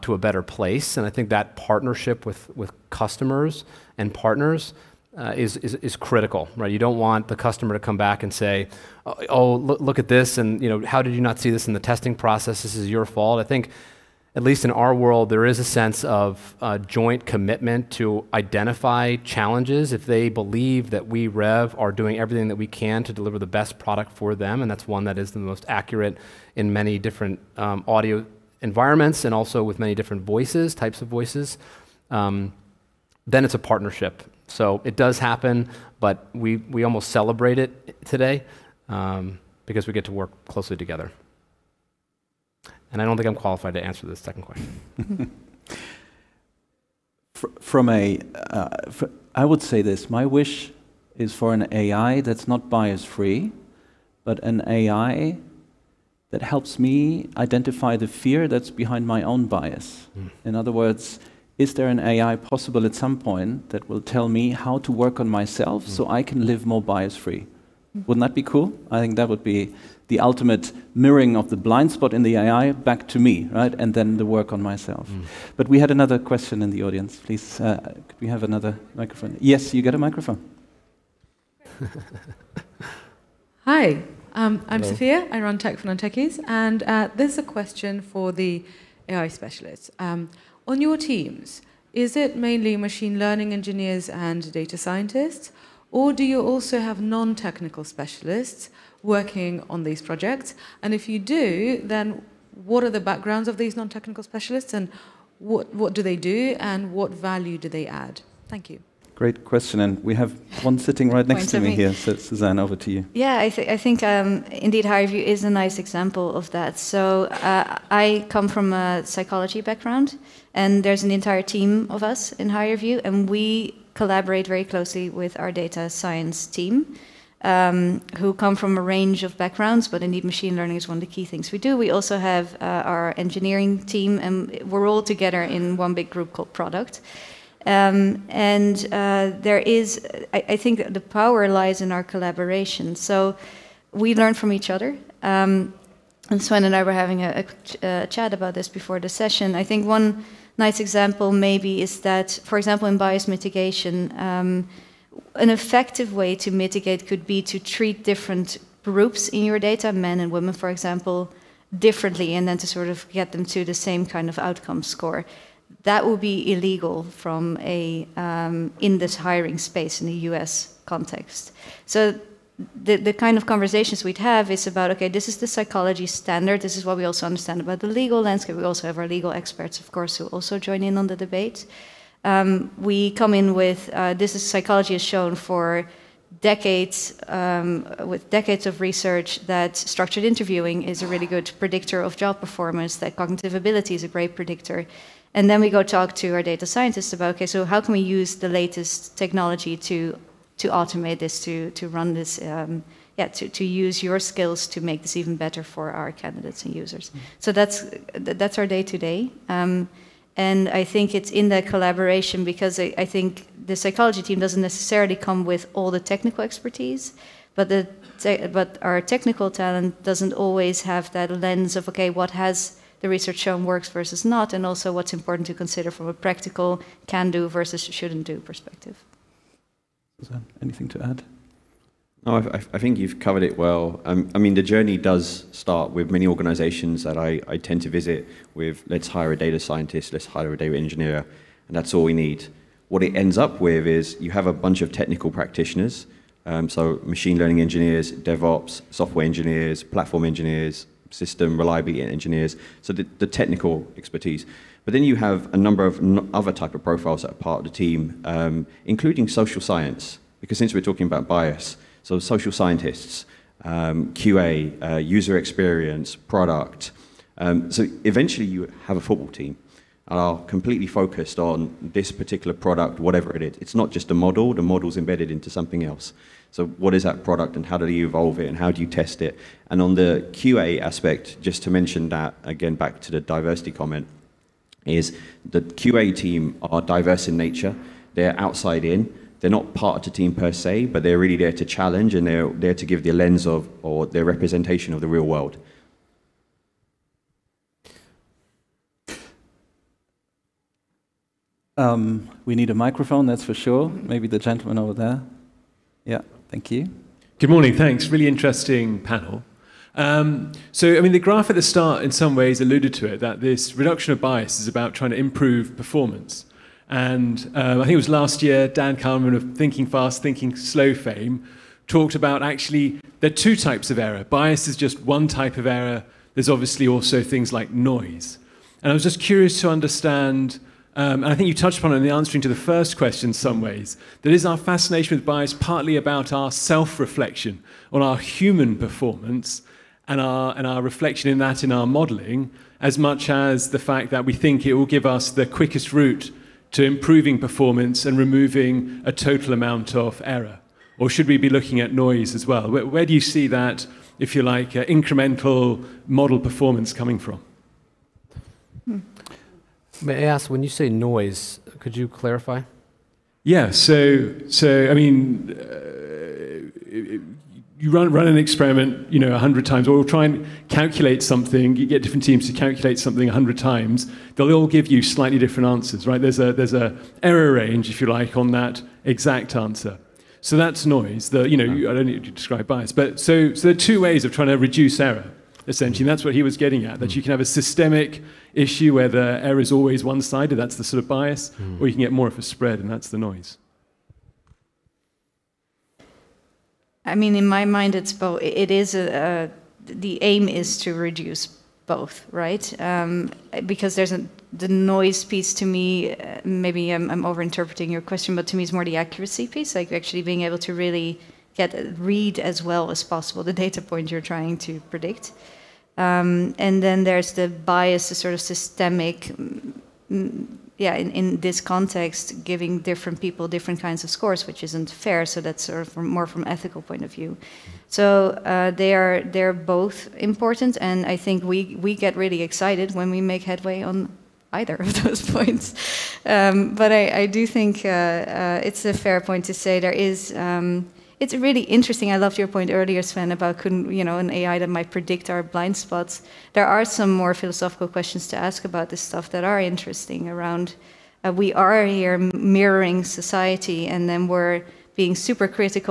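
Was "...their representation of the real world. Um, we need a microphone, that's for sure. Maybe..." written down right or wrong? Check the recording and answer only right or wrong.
right.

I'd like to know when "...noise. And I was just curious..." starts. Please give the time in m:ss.
5:27.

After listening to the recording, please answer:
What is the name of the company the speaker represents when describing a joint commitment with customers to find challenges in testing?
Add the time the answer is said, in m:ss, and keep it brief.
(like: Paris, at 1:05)
Rev, at 0:21.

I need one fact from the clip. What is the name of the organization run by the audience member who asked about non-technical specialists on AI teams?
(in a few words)
Tech for Non-Techies.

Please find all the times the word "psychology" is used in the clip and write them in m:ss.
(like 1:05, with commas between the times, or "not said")
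1:59, 2:55, 3:04, 3:33.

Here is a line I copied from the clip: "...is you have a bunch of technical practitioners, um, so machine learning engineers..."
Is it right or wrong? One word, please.
right.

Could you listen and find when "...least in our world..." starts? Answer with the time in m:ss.
0:14.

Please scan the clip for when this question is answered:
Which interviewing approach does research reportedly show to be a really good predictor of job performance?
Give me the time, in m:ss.
3:09.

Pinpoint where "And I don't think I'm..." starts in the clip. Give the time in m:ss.
0:42.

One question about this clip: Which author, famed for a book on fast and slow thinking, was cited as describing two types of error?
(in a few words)
Dan Kahneman.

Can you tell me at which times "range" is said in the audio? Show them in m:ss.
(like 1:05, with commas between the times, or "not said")
2:08, 6:17.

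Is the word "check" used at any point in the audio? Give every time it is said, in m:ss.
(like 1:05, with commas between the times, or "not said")
not said.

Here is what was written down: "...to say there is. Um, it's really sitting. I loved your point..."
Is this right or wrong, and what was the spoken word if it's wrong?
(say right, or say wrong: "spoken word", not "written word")
wrong: "interesting", not "sitting".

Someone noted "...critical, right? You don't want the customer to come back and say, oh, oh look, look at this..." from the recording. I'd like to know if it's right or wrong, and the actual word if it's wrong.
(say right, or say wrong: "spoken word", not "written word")
right.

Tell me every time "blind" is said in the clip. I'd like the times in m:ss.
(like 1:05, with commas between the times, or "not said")
1:11, 7:25.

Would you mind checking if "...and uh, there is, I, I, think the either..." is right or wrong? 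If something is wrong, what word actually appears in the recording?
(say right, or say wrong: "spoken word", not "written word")
wrong: "power", not "either".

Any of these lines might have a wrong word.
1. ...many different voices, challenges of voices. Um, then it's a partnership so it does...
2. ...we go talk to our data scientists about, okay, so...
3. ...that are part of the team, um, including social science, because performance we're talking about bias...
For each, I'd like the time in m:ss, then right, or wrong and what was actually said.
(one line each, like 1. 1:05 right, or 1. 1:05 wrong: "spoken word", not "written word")
1. 0:29 wrong: "types", not "challenges"
2. 3:15 right
3. 4:17 wrong: "since", not "performance".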